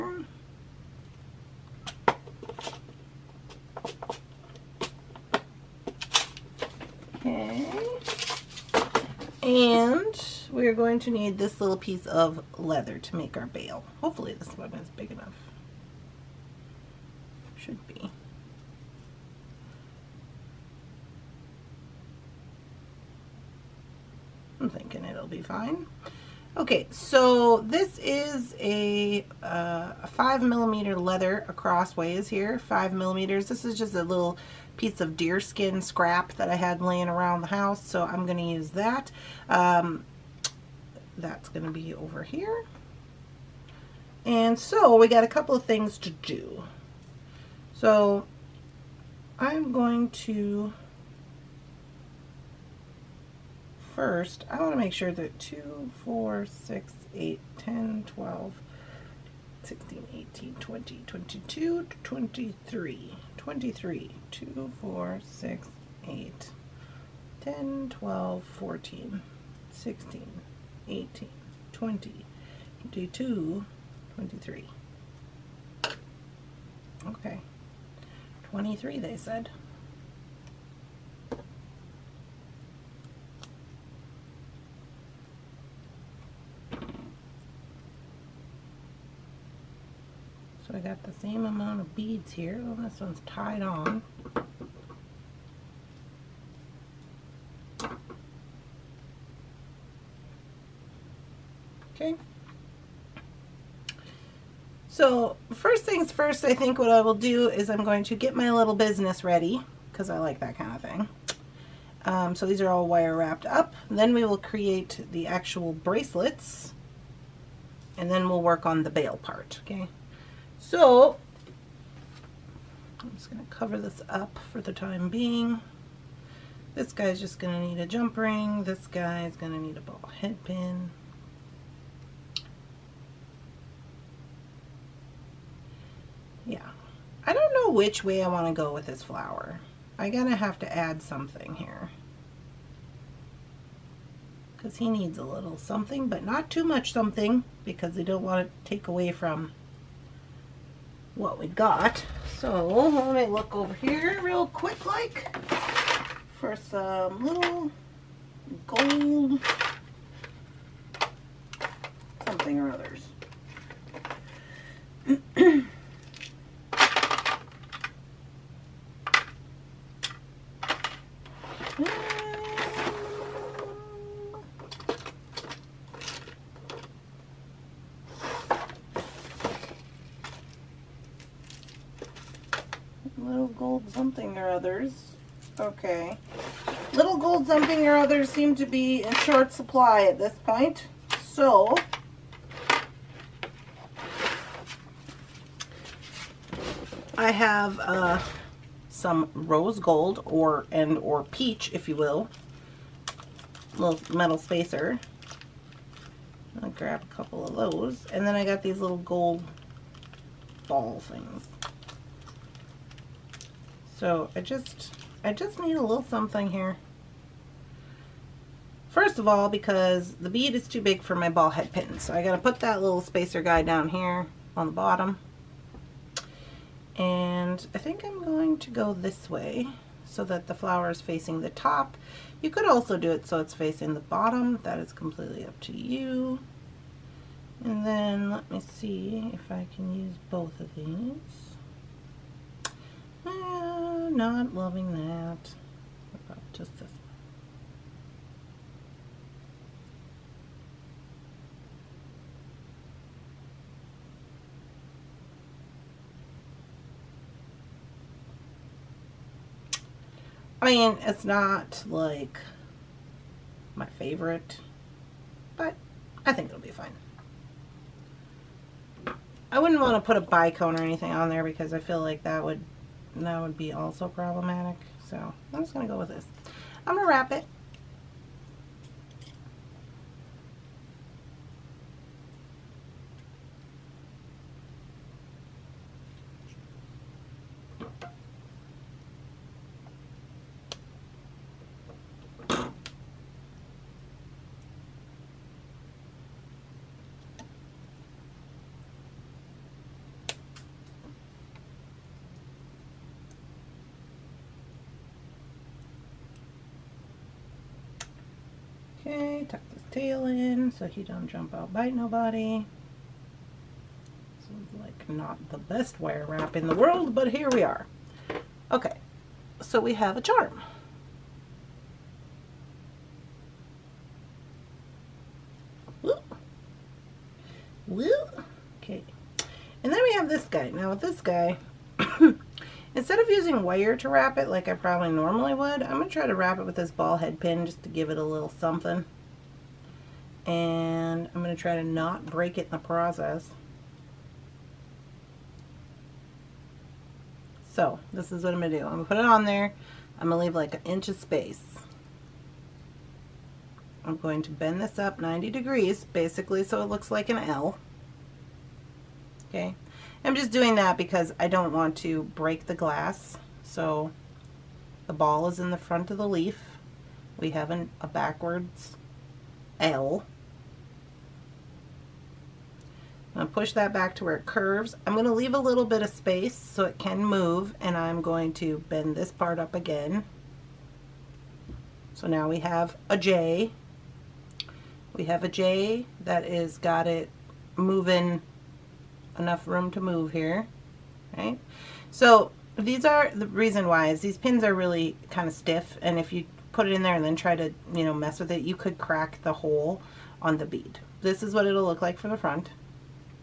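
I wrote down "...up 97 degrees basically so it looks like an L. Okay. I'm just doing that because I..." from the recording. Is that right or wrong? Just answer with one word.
wrong.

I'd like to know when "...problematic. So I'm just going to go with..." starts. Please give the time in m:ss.
4:34.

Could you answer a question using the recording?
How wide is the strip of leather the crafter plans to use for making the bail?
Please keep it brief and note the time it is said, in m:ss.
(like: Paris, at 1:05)
5 millimeters, at 0:32.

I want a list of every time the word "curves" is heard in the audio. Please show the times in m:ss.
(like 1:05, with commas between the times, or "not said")
6:14.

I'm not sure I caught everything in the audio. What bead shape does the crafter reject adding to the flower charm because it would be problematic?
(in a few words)
Bicone.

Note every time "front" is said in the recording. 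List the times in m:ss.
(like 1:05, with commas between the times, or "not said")
6:05, 6:42.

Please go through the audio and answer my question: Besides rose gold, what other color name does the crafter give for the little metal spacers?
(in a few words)
Peach.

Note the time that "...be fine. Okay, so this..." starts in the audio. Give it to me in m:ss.
0:25.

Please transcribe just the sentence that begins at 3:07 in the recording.
others seem to be in short supply at this point.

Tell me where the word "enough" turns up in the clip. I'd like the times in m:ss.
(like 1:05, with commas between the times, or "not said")
0:15, 6:29.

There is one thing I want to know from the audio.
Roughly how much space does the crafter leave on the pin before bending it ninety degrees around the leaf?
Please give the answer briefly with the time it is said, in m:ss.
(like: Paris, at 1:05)
An inch, at 5:50.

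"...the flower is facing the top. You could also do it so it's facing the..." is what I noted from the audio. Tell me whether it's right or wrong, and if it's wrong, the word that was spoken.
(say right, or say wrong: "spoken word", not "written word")
right.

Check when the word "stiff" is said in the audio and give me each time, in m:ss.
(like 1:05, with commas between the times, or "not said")
6:35.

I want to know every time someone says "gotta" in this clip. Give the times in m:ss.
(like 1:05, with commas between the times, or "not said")
2:20, 3:42.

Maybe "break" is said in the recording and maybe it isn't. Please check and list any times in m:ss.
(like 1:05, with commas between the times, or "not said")
5:42, 6:02.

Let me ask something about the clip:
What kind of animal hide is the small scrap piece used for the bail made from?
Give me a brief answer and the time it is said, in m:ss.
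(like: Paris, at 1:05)
Deerskin, at 0:35.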